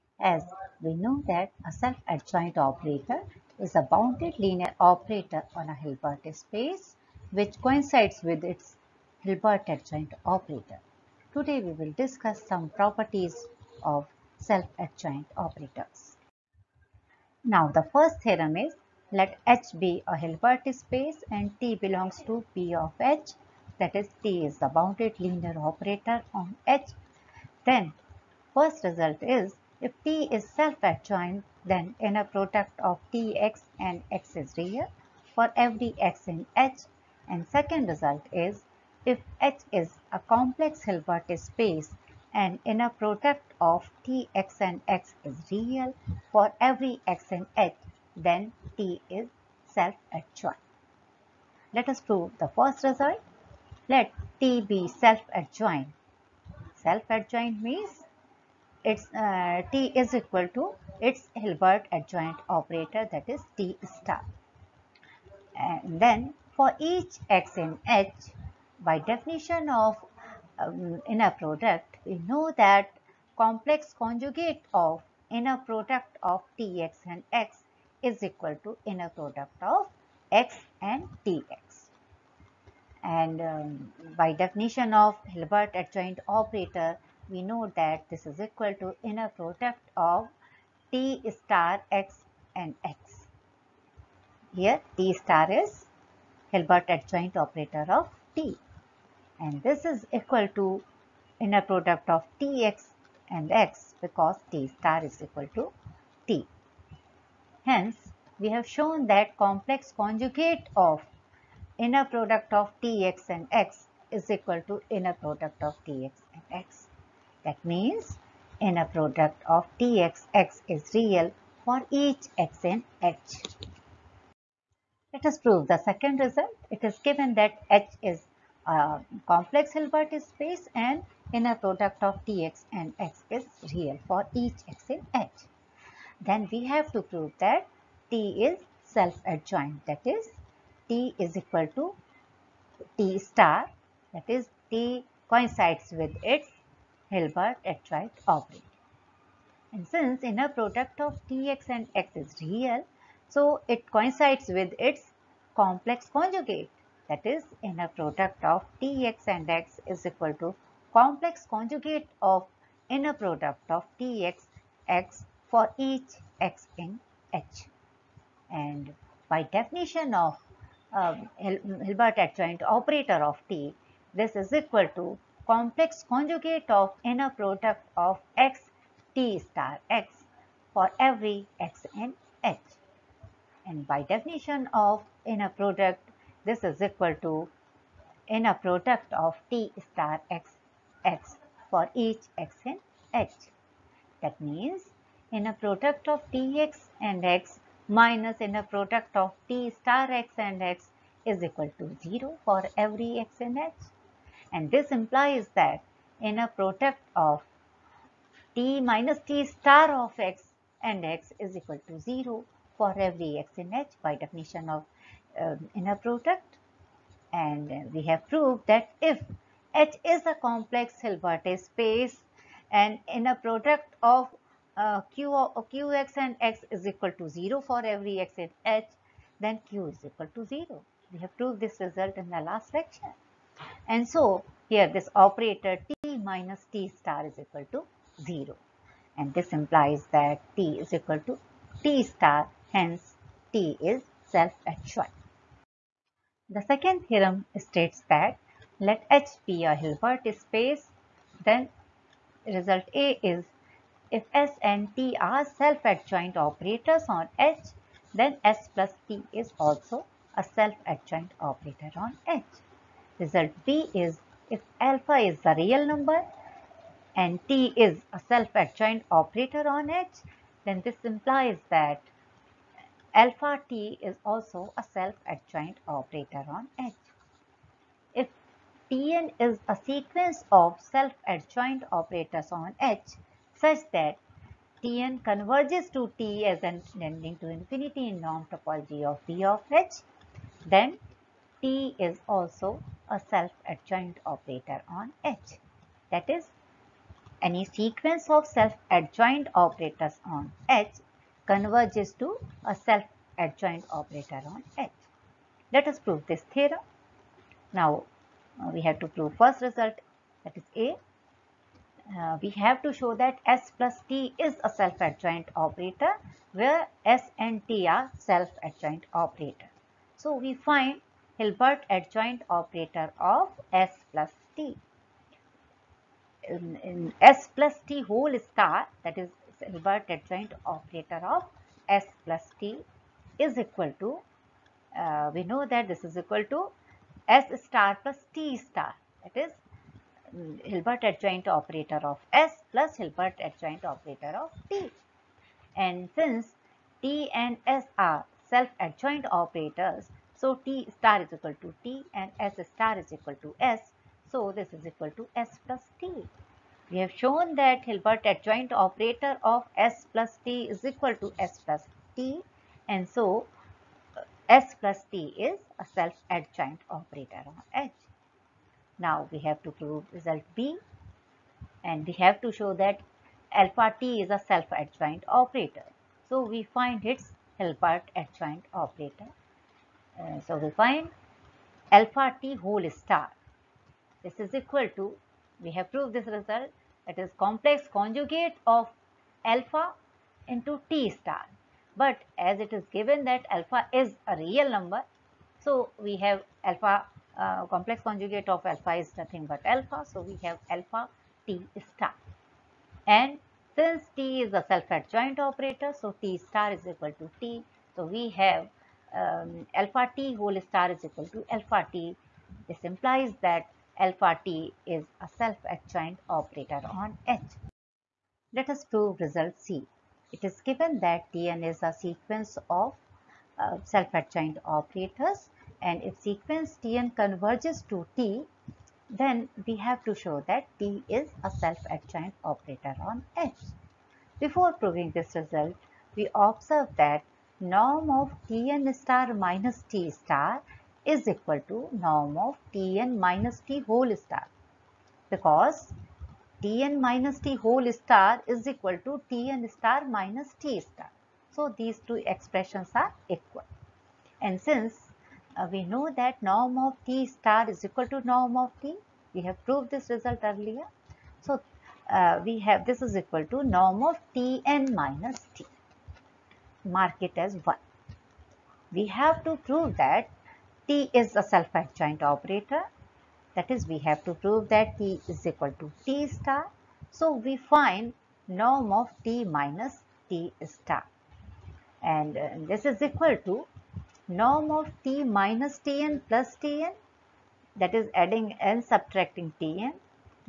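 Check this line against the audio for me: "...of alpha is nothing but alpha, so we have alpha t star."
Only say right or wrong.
right.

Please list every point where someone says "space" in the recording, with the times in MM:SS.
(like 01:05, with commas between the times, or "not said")
00:06, 00:20, 00:41, 02:10, 03:41, 04:10.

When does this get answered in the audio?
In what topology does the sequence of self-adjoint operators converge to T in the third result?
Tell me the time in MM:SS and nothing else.
04:48.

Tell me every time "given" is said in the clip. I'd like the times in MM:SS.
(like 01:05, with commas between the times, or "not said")
02:07, 06:32, 07:00.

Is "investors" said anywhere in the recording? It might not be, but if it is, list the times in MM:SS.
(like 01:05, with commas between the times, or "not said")
not said.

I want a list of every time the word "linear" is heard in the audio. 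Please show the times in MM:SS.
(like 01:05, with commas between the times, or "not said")
00:04, 00:25.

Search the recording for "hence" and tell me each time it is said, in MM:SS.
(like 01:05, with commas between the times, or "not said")
01:47, 04:02.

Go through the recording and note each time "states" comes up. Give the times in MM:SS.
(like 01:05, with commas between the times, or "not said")
04:07.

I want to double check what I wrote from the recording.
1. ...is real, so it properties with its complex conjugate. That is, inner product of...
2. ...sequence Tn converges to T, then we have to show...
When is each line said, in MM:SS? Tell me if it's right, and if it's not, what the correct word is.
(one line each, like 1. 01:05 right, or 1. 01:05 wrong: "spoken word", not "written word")
1. 02:32 wrong: "coincides", not "properties"
2. 07:06 right.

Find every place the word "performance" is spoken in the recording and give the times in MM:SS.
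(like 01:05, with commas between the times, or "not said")
not said.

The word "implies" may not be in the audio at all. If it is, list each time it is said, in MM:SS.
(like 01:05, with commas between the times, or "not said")
03:24, 03:59, 04:31, 06:52.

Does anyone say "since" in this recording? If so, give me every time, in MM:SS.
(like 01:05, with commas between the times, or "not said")
02:29, 05:46, 06:43, 07:34.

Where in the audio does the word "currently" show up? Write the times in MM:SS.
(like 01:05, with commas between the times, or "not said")
not said.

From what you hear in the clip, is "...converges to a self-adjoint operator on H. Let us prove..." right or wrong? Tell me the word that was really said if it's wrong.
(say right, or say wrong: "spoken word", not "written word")
right.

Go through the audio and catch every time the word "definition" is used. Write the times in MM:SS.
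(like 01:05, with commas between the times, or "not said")
01:08, 01:24, 02:49, 03:04, 03:34.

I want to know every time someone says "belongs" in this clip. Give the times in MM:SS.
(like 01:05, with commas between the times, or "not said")
00:21.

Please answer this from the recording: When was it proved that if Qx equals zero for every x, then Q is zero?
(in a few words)
In the last lecture.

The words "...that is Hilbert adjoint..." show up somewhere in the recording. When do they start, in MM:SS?
05:29.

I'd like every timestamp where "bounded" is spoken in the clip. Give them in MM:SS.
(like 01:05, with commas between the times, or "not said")
00:03, 00:24.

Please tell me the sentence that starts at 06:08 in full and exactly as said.
Now we have to prove result B and we have to show that alpha T is a self-adjoint operator.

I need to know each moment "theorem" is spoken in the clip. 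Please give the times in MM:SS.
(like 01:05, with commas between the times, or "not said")
00:18, 04:07, 05:06.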